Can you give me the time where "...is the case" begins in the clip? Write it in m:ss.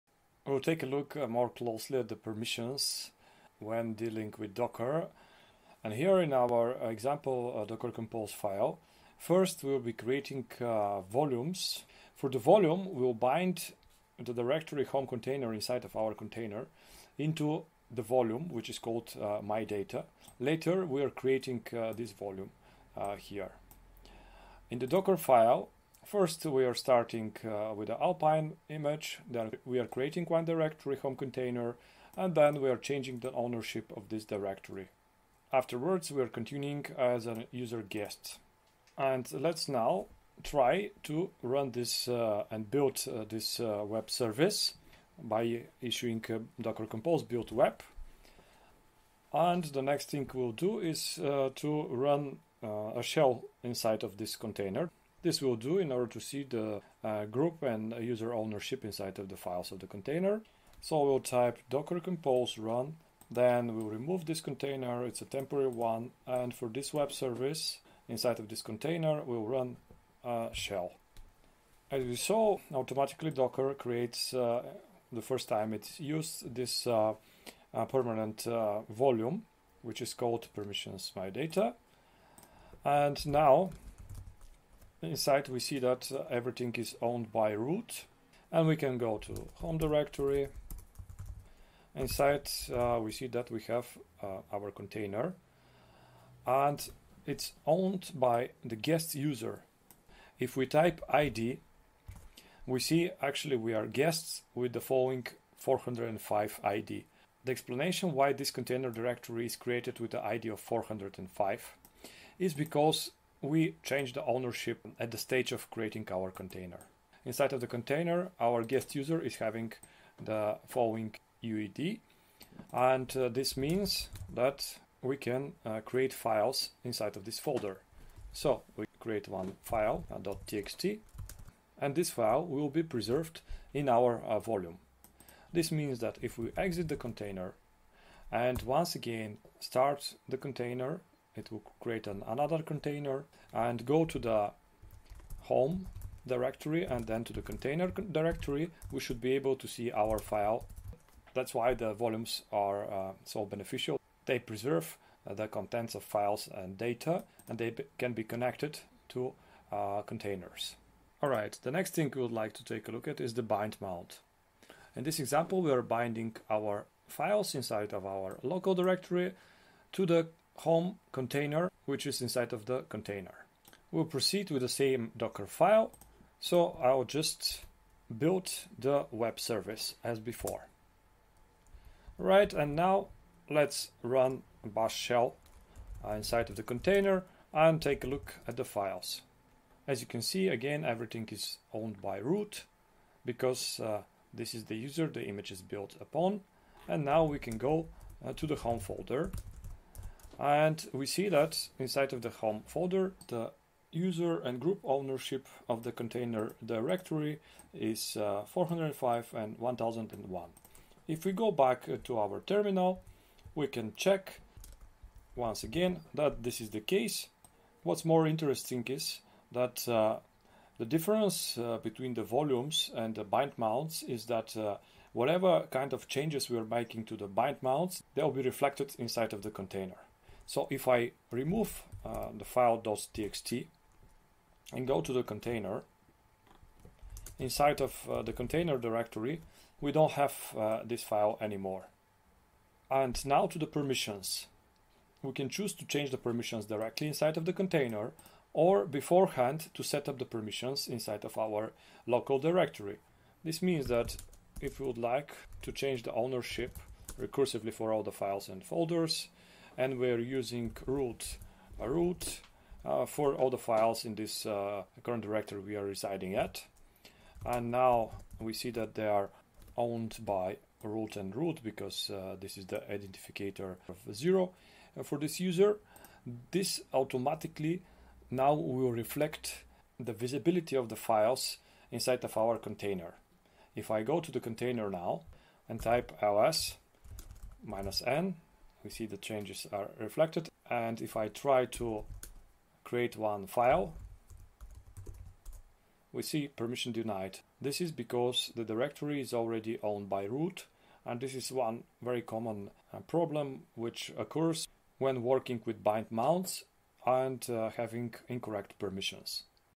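3:36.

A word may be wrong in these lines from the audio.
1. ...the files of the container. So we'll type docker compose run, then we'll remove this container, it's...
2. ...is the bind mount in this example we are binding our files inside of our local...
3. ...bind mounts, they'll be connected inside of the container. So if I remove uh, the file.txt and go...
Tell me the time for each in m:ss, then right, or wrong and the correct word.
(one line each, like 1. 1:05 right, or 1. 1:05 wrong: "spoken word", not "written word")
1. 0:59 right
2. 2:43 right
3. 3:47 wrong: "reflected", not "connected".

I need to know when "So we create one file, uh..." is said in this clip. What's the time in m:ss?
2:08.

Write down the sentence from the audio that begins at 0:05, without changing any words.
And here in our example uh, Docker Compose file, first we'll be creating uh, volumes.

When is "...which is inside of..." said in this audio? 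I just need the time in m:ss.
2:51.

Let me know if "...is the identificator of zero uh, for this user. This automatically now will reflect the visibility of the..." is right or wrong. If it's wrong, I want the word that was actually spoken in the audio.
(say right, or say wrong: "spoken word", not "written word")
right.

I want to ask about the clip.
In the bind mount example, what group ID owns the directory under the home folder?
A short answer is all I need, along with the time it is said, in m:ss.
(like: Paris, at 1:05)
1001, at 3:29.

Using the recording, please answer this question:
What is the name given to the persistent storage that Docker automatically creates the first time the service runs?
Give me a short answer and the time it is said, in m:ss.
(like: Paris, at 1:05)
permissions my data, at 1:20.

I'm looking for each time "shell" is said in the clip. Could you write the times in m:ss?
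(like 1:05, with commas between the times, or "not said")
0:53, 1:10, 3:04.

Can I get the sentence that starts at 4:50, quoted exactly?
And if I try to create one file, we see permission denied.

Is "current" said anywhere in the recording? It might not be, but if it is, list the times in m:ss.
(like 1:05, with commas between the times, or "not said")
4:25.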